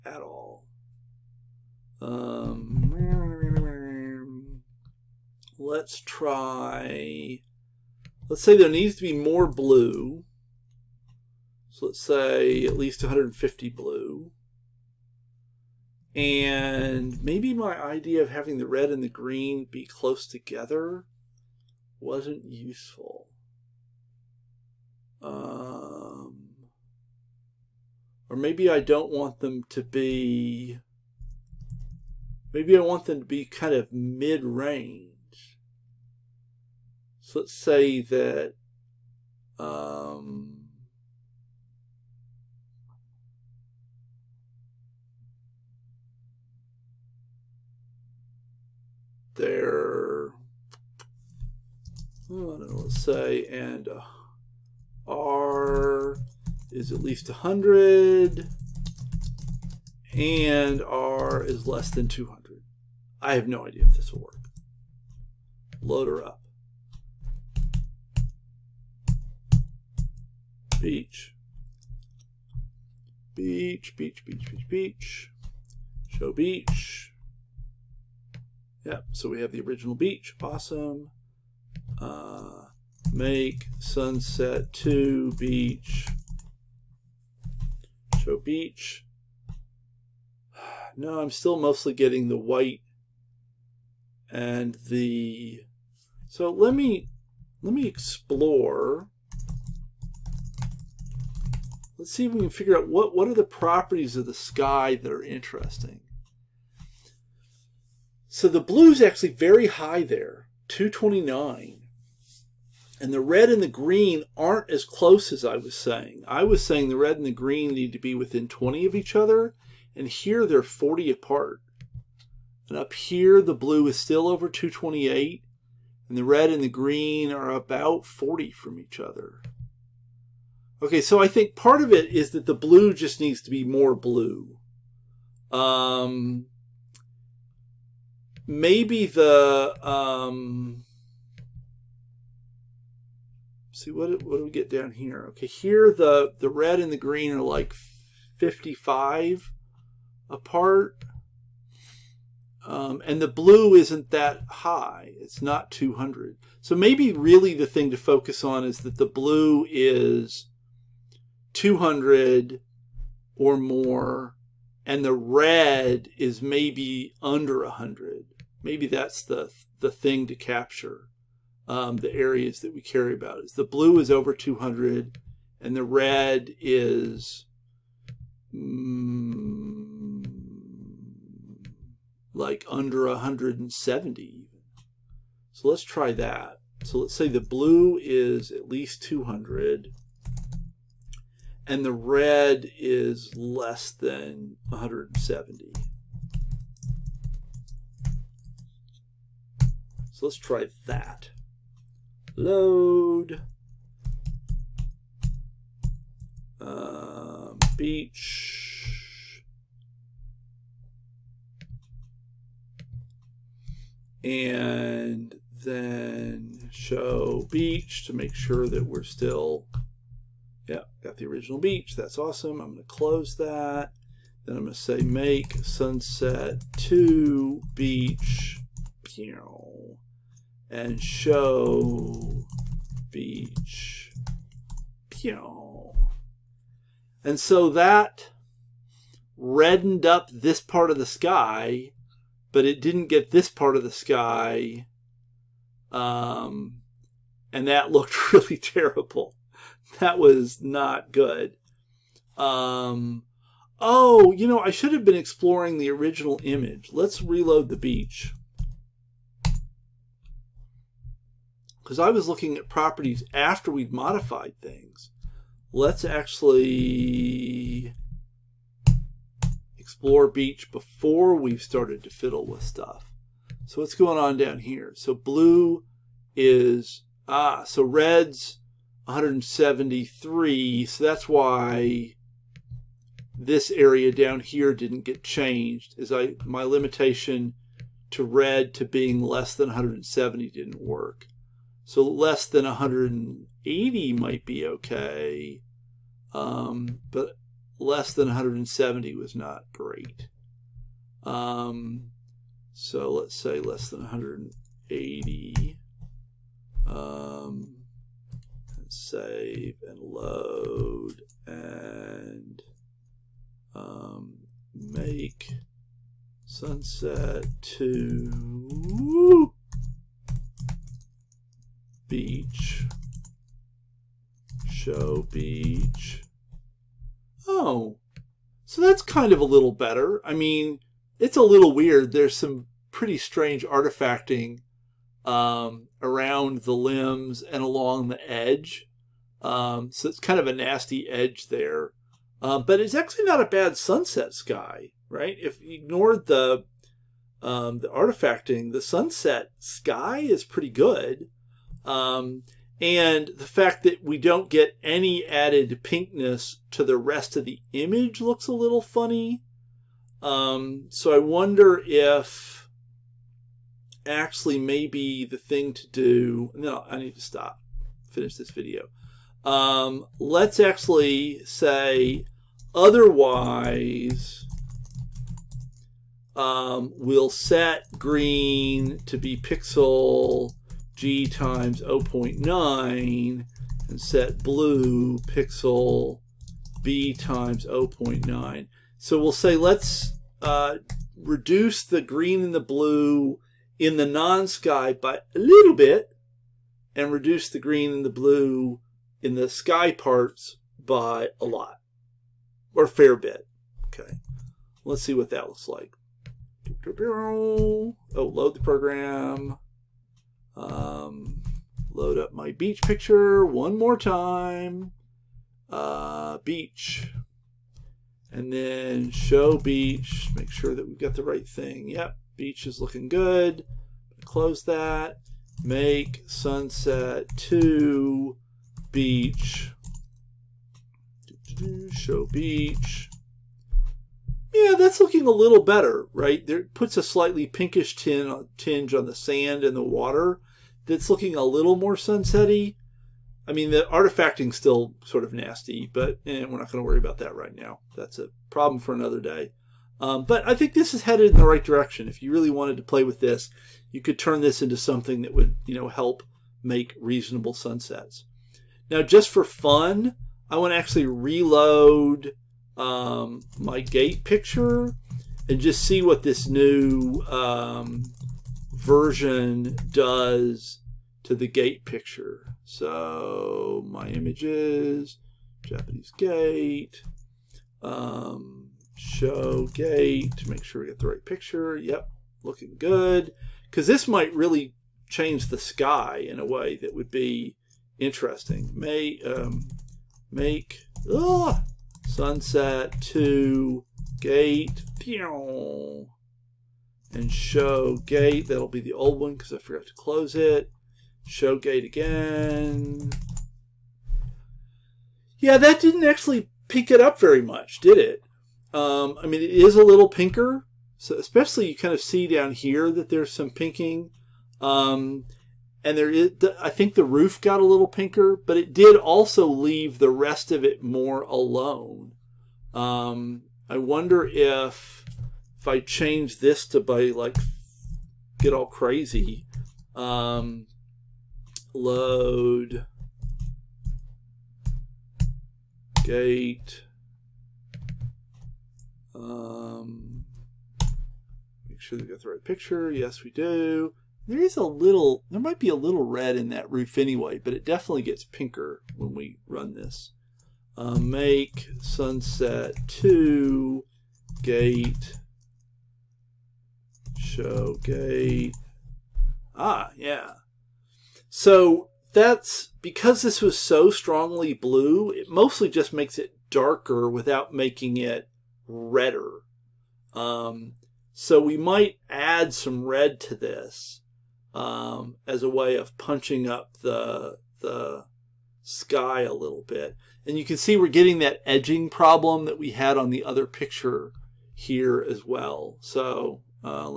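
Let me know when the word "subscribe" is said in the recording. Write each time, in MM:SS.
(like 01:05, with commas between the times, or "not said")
not said.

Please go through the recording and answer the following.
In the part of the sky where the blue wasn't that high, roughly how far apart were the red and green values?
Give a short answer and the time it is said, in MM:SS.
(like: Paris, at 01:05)
55, at 02:27.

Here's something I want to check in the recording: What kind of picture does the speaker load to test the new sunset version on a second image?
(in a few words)
Japanese gate.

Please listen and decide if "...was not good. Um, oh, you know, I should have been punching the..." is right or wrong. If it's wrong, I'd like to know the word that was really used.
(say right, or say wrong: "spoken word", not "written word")
wrong: "exploring", not "punching".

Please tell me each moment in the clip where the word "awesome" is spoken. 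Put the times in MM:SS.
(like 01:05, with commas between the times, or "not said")
01:20, 03:42.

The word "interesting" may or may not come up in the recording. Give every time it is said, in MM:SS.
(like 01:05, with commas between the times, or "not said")
01:45, 08:07.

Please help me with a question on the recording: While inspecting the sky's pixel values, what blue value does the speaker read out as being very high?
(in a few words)
229.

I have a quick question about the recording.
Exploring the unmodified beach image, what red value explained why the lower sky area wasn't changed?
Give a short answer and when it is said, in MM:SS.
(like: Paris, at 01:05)
173, at 04:37.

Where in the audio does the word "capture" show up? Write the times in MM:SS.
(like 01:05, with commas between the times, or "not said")
02:50.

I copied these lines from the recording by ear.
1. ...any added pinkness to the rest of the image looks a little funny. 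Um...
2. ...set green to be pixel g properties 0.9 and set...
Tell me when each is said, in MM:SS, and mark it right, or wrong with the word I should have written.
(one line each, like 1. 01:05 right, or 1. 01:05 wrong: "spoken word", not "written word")
1. 05:54 right
2. 06:17 wrong: "times", not "properties".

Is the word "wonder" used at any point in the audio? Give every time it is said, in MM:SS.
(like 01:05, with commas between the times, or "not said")
06:01, 08:43.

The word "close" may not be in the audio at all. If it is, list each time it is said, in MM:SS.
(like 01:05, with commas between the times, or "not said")
00:19, 01:54, 03:42, 07:04, 08:19.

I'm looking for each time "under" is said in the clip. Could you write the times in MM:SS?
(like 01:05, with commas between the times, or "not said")
02:47, 03:02.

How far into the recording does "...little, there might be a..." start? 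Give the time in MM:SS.
09:04.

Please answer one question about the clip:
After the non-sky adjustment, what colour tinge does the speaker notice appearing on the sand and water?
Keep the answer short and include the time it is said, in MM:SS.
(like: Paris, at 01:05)
pinkish, at 07:17.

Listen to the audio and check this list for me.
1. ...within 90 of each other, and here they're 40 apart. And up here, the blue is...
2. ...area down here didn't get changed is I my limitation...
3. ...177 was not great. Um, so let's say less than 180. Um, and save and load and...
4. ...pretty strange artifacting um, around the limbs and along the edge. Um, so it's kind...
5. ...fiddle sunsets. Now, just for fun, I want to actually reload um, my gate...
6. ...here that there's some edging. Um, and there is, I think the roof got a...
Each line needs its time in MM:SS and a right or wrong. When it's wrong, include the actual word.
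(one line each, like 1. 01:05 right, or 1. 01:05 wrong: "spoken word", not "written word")
1. 01:58 wrong: "20", not "90"
2. 04:43 right
3. 04:58 wrong: "170", not "177"
4. 05:32 right
5. 07:36 wrong: "reasonable", not "fiddle"
6. 08:32 wrong: "pinking", not "edging".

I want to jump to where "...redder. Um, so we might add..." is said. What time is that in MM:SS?
09:28.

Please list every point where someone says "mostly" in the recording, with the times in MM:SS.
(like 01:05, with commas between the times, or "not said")
01:31, 09:25.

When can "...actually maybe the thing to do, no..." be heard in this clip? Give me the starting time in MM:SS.
06:04.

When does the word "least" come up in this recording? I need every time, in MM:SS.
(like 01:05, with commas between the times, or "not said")
00:12, 00:57, 03:08.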